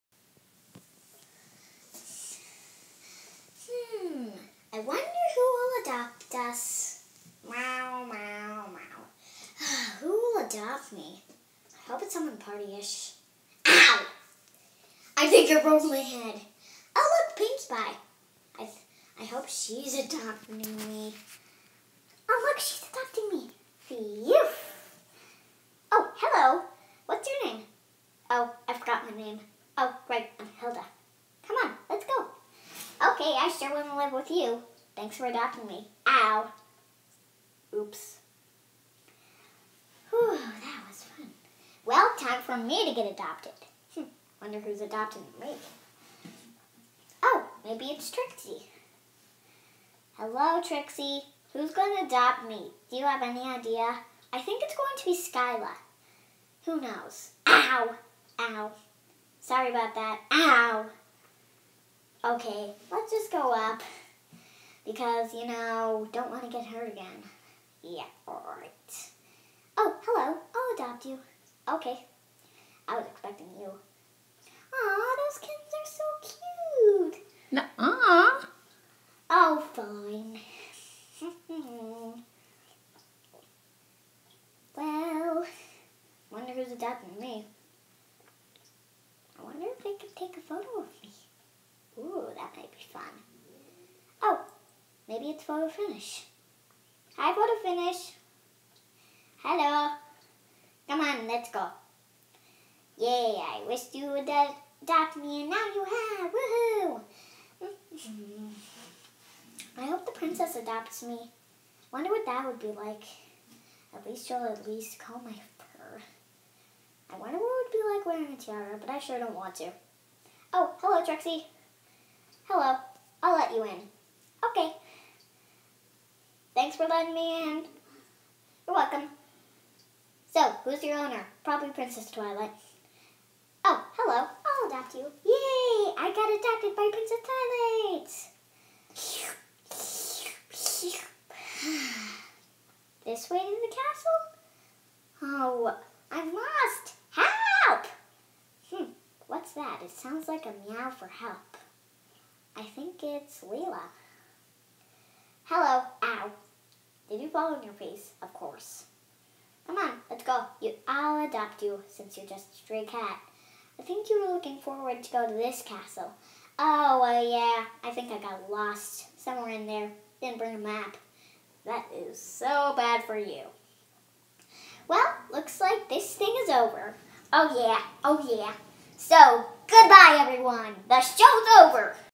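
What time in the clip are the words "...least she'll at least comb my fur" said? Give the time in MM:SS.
01:54.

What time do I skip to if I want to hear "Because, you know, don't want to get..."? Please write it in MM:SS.
01:04.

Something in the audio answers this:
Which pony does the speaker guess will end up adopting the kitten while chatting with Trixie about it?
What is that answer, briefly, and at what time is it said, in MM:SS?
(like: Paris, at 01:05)
Skyla, at 00:55.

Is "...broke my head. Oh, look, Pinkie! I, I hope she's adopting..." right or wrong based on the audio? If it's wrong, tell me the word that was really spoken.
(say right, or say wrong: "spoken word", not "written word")
right.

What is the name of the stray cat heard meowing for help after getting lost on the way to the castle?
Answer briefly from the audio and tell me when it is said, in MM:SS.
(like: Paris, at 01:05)
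Leela, at 02:33.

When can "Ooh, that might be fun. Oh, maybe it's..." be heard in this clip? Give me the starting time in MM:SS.
01:31.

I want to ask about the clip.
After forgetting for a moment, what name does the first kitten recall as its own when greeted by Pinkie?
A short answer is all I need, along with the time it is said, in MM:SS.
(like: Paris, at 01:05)
Hilda, at 00:30.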